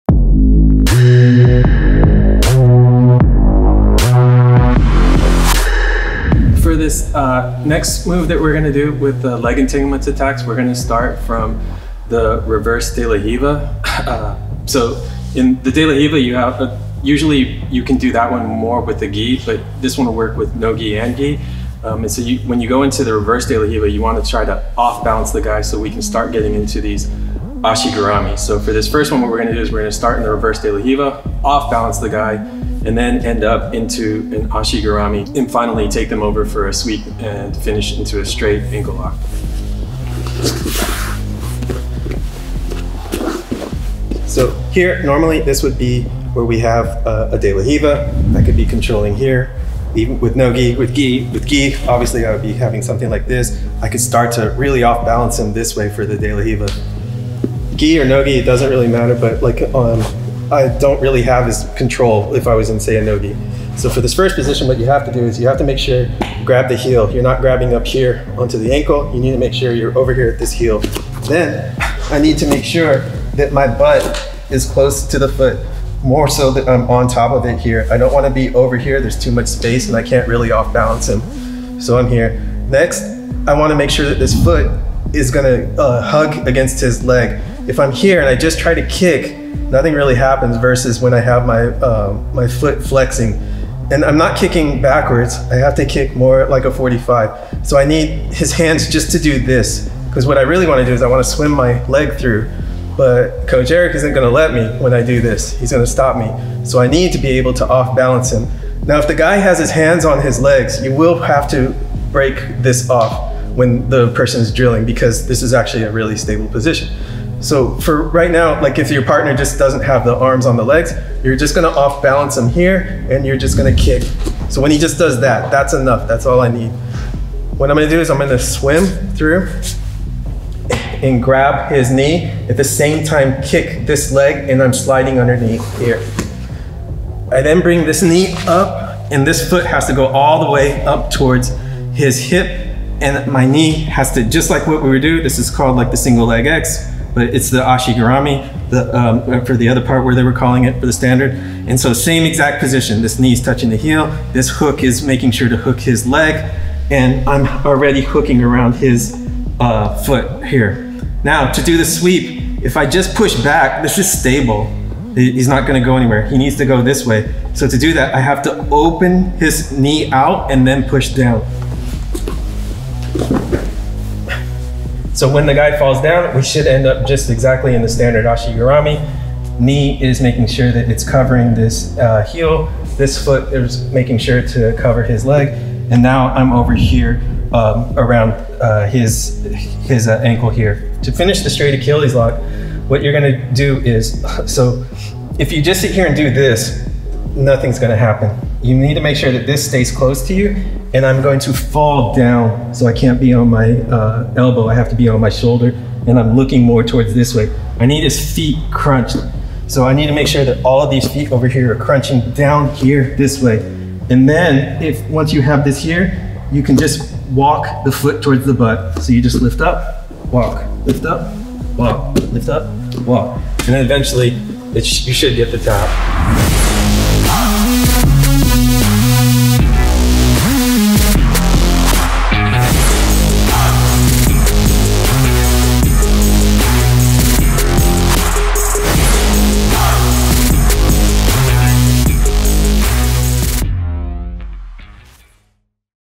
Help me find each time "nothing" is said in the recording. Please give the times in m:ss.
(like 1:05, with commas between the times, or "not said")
1:29, 3:17.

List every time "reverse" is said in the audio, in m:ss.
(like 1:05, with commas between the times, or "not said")
0:12, 0:23, 0:30.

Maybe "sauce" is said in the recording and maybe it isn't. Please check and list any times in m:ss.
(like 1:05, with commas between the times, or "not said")
not said.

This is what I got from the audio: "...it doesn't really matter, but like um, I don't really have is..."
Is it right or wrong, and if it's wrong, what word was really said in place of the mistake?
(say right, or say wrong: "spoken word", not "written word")
right.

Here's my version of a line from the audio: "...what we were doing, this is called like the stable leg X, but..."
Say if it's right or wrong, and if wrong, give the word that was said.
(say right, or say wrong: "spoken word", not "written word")
wrong: "single", not "stable".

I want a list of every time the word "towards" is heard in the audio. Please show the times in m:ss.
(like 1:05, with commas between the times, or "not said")
2:21, 3:26, 3:38.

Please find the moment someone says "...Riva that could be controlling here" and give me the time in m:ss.
0:47.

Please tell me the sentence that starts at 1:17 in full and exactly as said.
I don't want to be over here.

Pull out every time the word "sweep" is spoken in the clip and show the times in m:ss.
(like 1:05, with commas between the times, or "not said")
0:36, 2:41.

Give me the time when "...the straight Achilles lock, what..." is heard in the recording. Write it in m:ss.
3:11.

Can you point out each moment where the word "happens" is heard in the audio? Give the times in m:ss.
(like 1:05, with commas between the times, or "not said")
1:30, 3:17.